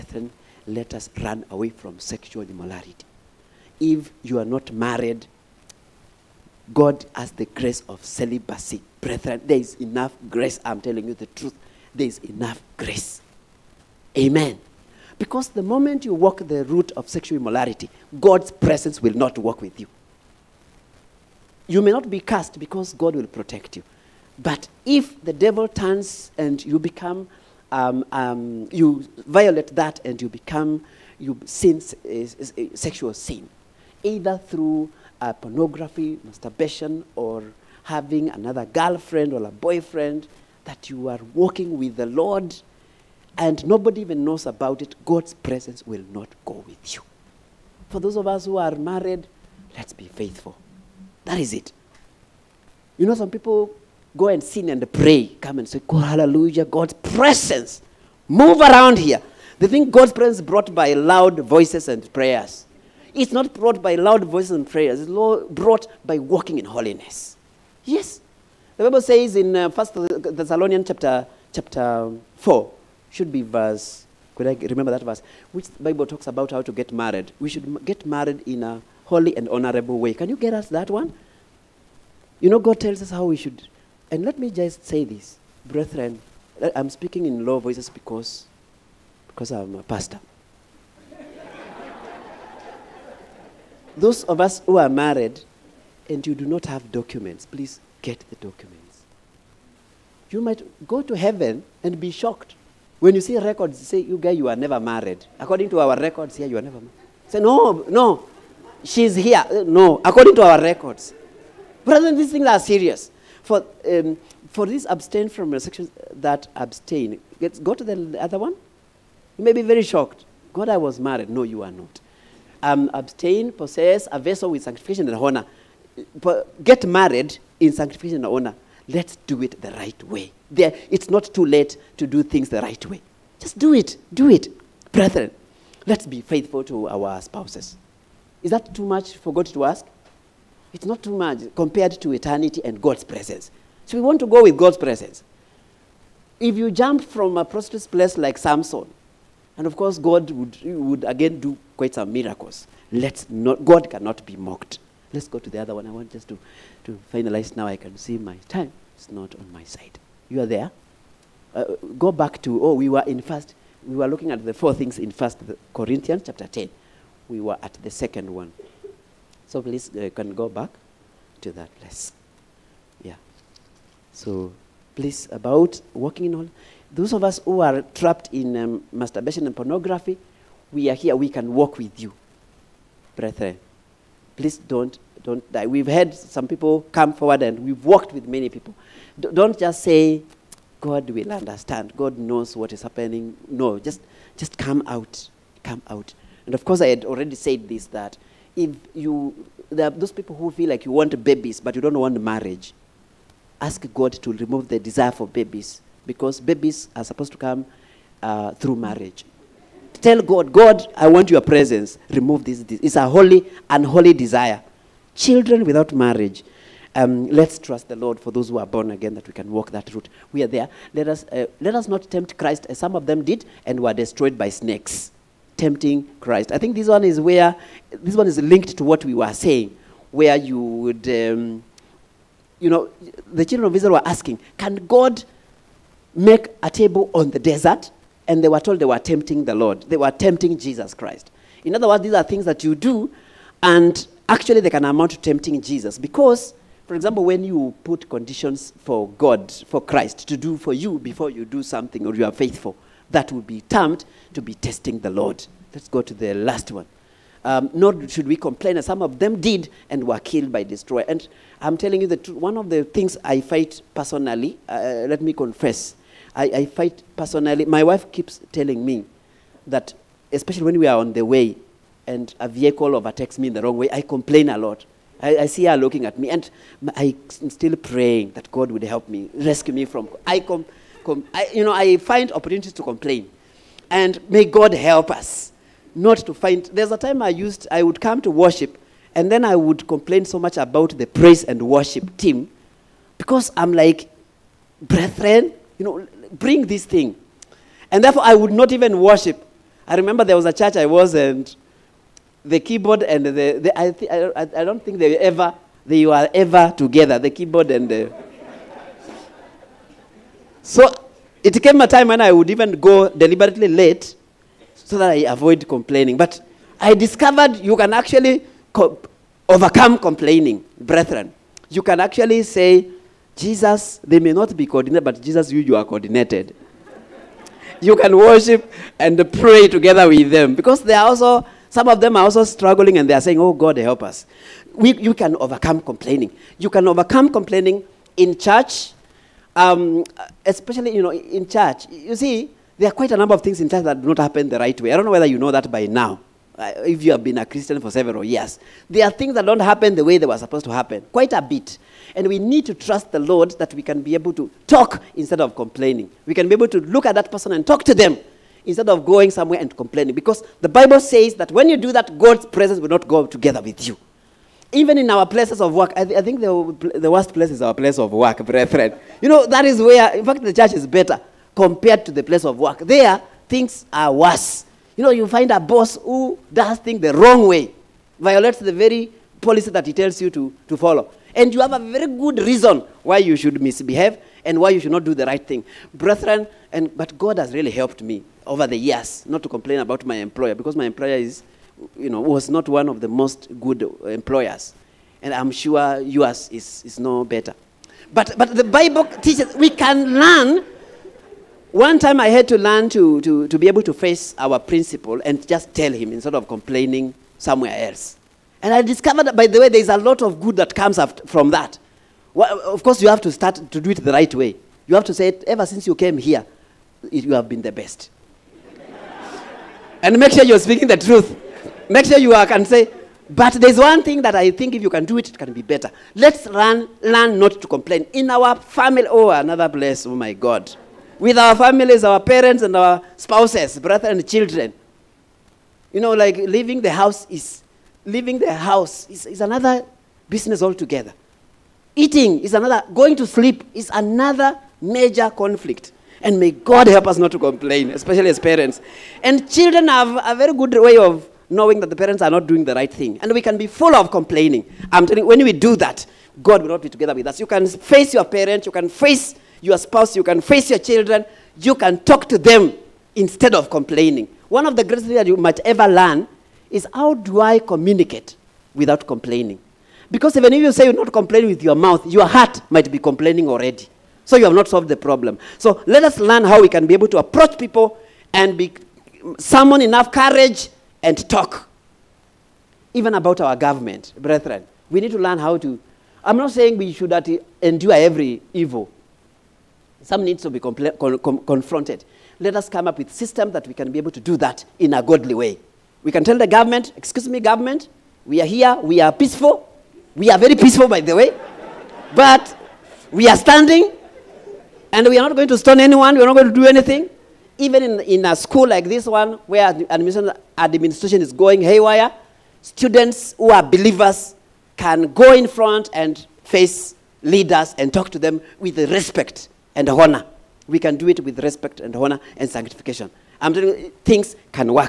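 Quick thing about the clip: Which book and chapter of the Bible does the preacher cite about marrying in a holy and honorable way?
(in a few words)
First Thessalonians 4.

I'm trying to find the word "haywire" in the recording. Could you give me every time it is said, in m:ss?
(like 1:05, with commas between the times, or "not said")
8:31.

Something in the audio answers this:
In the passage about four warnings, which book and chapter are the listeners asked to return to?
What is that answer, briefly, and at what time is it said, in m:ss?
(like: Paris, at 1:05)
First Corinthians 10, at 2:45.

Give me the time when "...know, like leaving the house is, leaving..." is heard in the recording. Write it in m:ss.
7:16.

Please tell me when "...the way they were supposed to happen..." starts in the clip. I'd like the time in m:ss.
5:49.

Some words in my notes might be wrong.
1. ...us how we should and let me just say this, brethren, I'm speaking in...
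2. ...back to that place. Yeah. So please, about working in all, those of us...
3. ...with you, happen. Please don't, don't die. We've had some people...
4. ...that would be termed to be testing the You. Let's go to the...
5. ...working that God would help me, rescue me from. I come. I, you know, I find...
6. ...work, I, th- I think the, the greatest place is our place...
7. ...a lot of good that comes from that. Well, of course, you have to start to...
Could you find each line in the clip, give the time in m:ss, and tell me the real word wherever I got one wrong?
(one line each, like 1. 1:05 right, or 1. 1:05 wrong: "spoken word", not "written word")
1. 1:23 right
2. 2:50 right
3. 3:01 wrong: "brethren", not "happen"
4. 4:13 wrong: "Lord", not "You"
5. 4:37 wrong: "praying", not "working"
6. 6:05 wrong: "worst", not "greatest"
7. 6:49 right.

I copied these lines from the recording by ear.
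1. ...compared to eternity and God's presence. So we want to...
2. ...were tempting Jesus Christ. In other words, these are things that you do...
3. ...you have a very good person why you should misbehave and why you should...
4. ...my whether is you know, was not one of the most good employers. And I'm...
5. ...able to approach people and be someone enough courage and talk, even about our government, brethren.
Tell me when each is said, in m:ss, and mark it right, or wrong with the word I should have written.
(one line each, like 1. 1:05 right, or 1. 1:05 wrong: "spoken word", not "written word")
1. 2:21 right
2. 3:59 right
3. 6:21 wrong: "reason", not "person"
4. 6:30 wrong: "employer", not "whether"
5. 7:56 right.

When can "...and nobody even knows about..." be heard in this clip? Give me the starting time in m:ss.
0:43.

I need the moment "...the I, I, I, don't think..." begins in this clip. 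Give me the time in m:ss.
5:03.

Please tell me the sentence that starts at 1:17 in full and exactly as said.
We should get married in a holy and honorable way.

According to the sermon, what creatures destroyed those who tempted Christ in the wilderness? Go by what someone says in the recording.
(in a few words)
Snakes.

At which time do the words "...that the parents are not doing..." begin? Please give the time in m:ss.
7:31.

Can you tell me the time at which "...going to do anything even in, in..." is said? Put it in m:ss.
8:26.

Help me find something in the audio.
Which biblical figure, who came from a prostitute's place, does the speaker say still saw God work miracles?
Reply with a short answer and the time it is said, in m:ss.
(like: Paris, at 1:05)
Samson, at 2:28.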